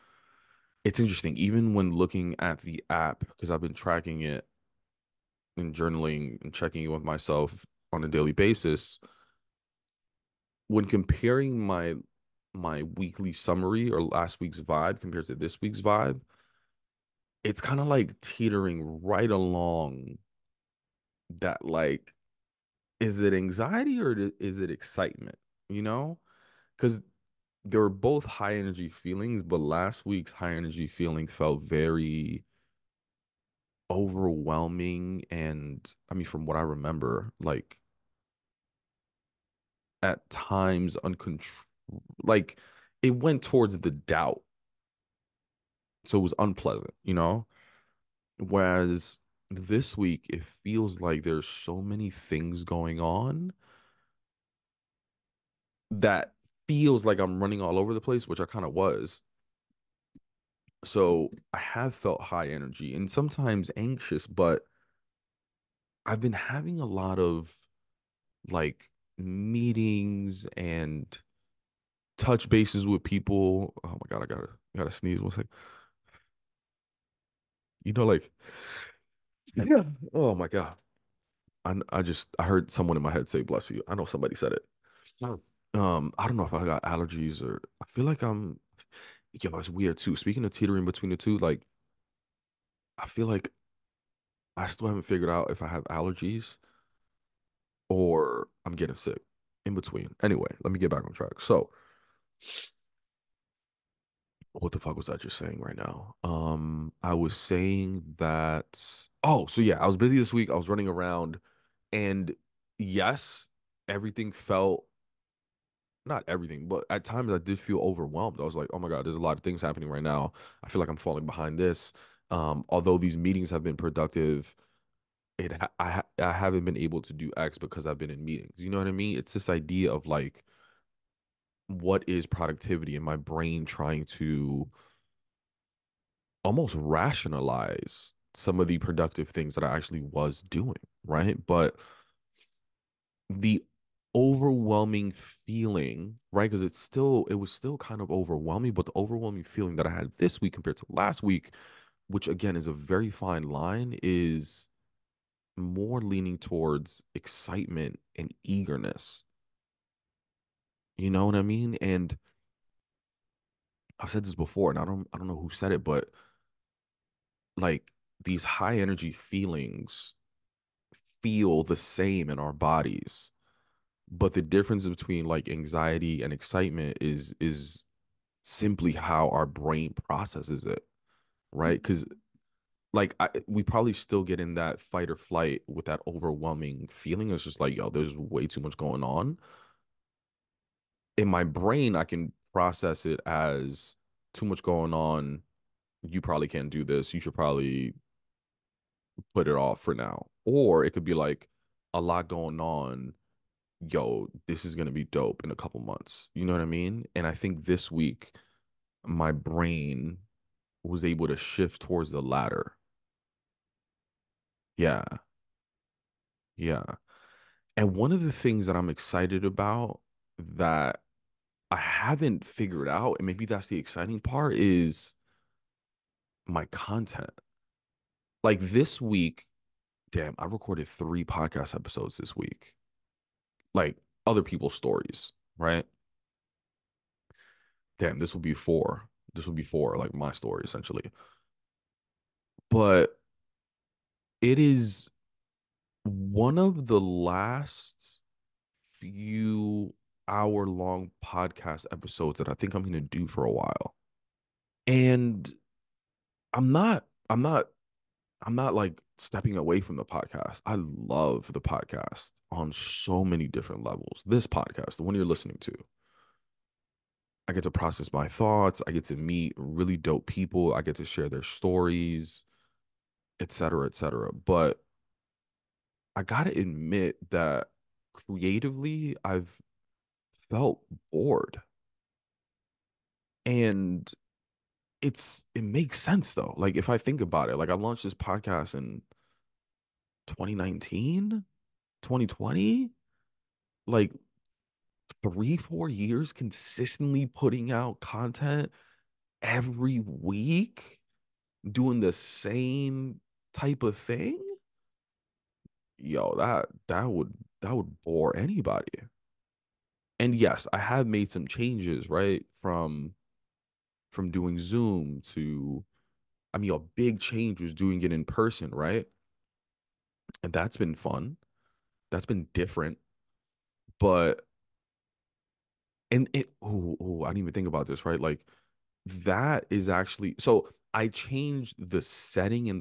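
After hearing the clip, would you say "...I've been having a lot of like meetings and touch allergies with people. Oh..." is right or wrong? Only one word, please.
wrong.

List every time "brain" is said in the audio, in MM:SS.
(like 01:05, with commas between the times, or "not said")
02:13, 02:59, 03:11, 03:29.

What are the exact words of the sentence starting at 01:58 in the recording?
I was like, oh my god, there's a lot of things happening right now.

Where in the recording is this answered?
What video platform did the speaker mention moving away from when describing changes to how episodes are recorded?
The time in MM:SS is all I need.
05:14.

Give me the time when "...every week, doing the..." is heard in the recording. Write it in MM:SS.
04:59.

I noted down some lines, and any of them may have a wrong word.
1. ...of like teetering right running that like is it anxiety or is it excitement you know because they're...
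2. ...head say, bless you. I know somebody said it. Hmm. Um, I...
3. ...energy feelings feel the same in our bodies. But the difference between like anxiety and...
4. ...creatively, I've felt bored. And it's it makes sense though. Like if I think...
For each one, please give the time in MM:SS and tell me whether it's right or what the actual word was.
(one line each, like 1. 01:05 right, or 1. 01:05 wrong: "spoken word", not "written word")
1. 00:17 wrong: "along", not "running"
2. 01:23 right
3. 02:48 right
4. 04:38 right.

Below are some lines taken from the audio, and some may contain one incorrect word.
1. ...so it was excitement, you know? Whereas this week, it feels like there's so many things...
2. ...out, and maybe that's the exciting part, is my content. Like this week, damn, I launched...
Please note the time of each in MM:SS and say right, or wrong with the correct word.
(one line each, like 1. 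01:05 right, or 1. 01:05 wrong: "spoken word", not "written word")
1. 00:46 wrong: "unpleasant", not "excitement"
2. 03:42 wrong: "recorded", not "launched".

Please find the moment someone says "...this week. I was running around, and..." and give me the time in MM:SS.
01:50.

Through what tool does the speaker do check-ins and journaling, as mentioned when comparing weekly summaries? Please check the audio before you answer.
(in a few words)
the app.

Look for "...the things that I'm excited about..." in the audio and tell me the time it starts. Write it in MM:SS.
03:38.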